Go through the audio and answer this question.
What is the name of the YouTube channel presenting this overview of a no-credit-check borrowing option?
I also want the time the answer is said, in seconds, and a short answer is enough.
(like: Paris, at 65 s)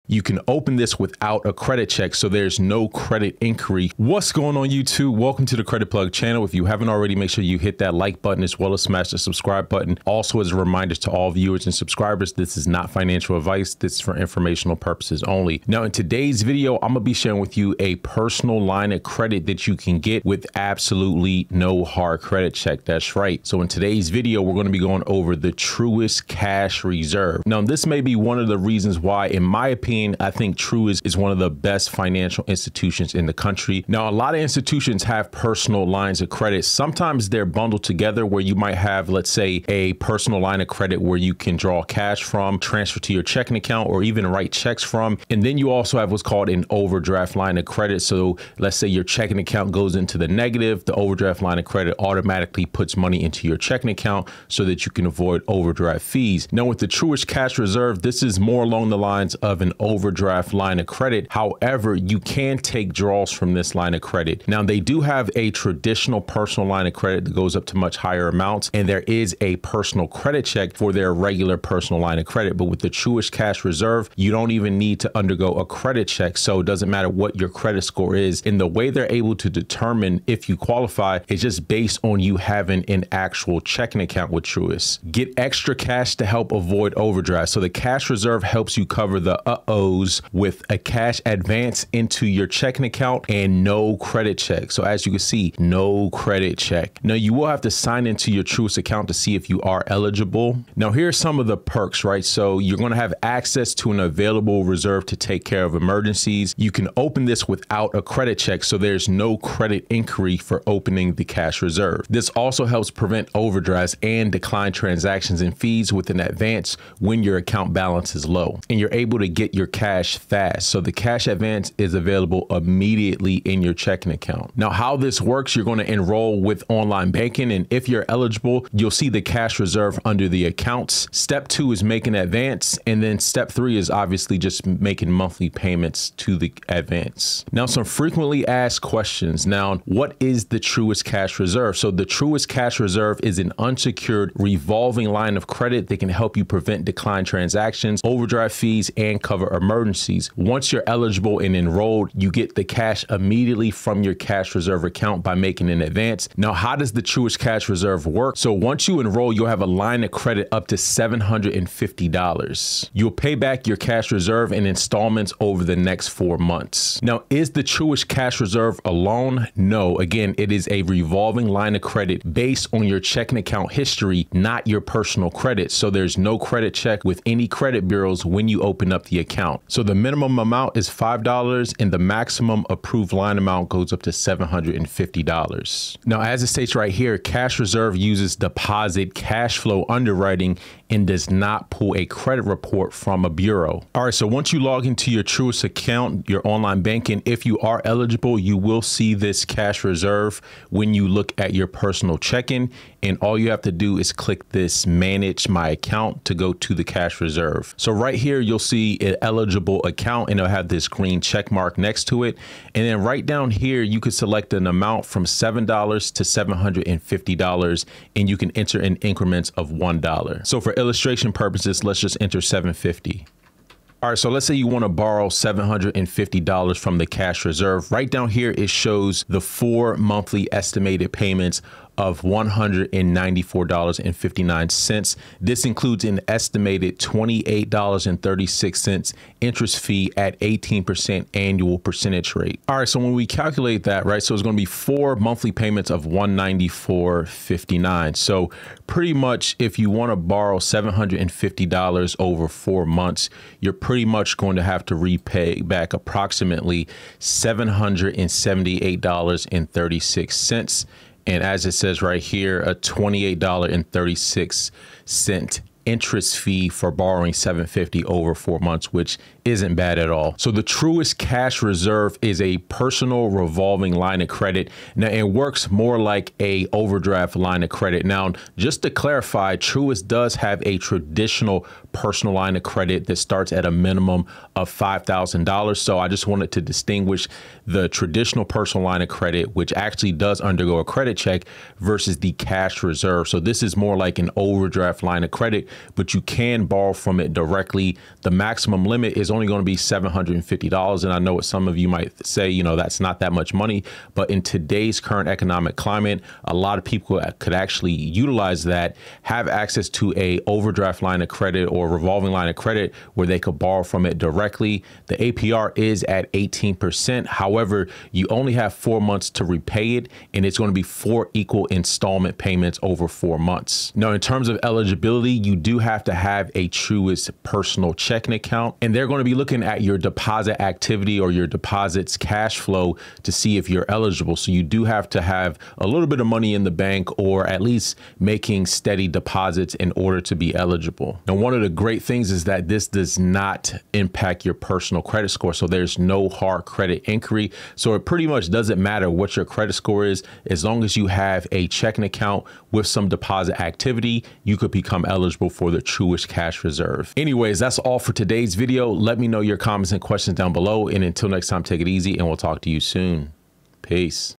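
Credit Plug, at 5 s.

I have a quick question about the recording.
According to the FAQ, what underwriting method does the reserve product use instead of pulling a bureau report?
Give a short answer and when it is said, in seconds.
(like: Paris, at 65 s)
deposit cash flow underwriting, at 188 s.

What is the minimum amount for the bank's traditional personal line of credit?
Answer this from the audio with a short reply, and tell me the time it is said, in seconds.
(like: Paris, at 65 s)
$5,000, at 284 s.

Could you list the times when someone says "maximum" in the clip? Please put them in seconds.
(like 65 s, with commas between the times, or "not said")
181 s, 298 s.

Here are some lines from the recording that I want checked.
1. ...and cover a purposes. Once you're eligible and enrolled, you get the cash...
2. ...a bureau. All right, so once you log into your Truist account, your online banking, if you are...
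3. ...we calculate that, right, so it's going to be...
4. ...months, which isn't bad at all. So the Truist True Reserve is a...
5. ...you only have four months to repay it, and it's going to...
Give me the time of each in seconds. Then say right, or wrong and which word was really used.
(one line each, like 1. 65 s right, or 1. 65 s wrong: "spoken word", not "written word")
1. 148 s wrong: "emergencies", not "purposes"
2. 193 s right
3. 243 s right
4. 268 s wrong: "Cash", not "True"
5. 318 s right.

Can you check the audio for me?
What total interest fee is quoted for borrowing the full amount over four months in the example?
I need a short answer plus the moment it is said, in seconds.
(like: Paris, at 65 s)
$28.36, at 236 s.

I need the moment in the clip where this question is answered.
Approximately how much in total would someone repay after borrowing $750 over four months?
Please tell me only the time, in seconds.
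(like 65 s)
257 s.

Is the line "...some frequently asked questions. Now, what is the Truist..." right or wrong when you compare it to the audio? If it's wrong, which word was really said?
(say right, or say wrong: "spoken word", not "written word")
right.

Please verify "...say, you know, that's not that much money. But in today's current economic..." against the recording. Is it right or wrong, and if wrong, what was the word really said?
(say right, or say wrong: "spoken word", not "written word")
right.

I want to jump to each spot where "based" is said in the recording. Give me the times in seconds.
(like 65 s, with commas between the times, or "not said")
81 s, 172 s.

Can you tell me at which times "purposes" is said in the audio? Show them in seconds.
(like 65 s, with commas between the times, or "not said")
14 s, 221 s.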